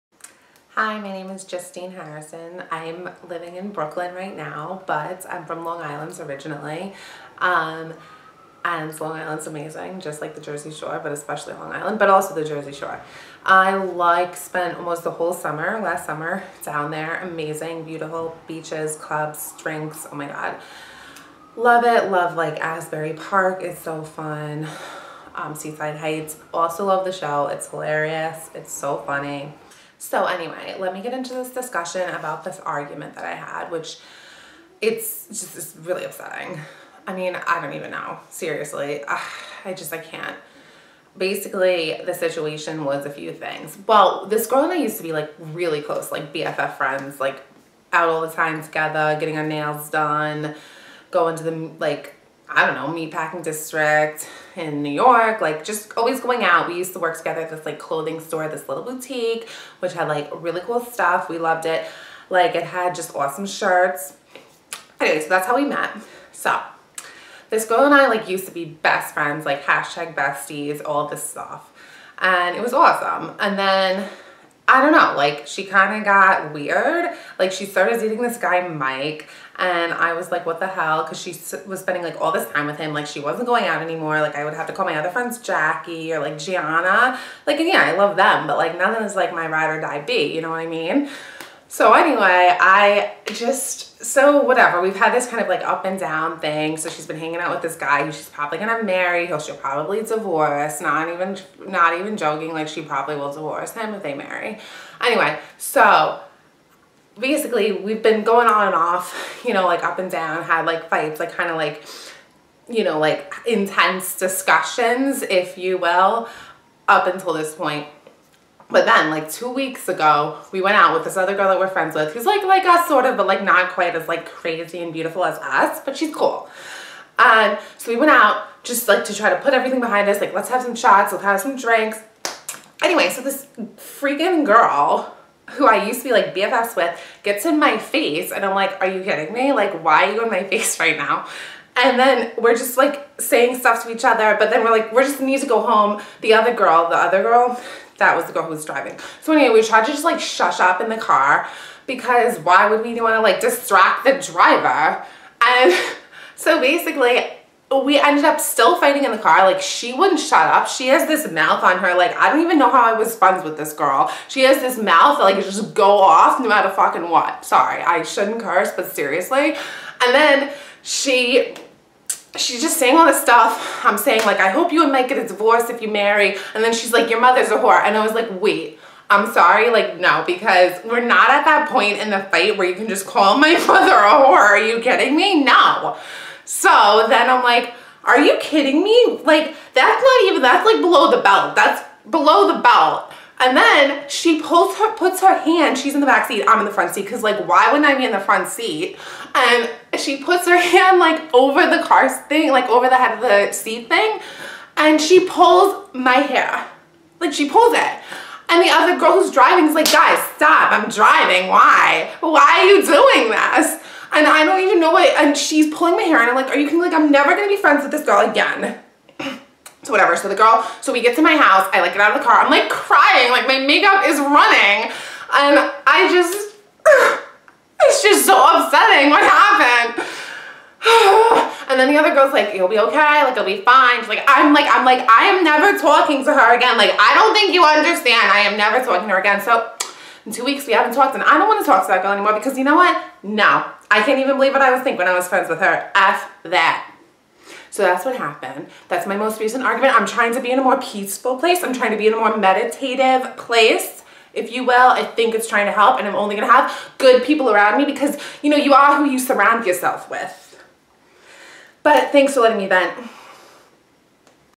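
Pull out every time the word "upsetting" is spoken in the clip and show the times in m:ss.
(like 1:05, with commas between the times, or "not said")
0:36, 3:48.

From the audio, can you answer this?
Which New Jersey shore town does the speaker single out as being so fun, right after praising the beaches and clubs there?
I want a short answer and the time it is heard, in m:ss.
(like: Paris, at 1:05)
Asbury Park, at 0:22.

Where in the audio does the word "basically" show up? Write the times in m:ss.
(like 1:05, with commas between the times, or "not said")
0:41, 1:47, 2:36.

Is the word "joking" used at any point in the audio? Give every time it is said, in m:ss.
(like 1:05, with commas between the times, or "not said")
1:42.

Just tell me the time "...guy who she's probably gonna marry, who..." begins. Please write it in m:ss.
1:37.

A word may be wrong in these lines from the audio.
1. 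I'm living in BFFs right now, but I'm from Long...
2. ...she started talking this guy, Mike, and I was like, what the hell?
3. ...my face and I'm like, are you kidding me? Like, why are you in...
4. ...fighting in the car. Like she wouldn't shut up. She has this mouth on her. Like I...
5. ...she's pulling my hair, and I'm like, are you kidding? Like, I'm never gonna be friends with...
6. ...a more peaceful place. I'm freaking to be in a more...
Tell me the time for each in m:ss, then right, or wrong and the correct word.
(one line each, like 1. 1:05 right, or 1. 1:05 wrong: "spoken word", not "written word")
1. 0:02 wrong: "Brooklyn", not "BFFs"
2. 1:17 wrong: "dating", not "talking"
3. 2:17 right
4. 2:38 right
5. 3:35 right
6. 4:10 wrong: "trying", not "freaking".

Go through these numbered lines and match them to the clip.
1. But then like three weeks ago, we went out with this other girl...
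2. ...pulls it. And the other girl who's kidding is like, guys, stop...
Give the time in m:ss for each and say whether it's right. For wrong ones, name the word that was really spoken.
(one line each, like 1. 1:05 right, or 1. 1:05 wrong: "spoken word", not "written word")
1. 1:58 wrong: "two", not "three"
2. 3:27 wrong: "driving", not "kidding".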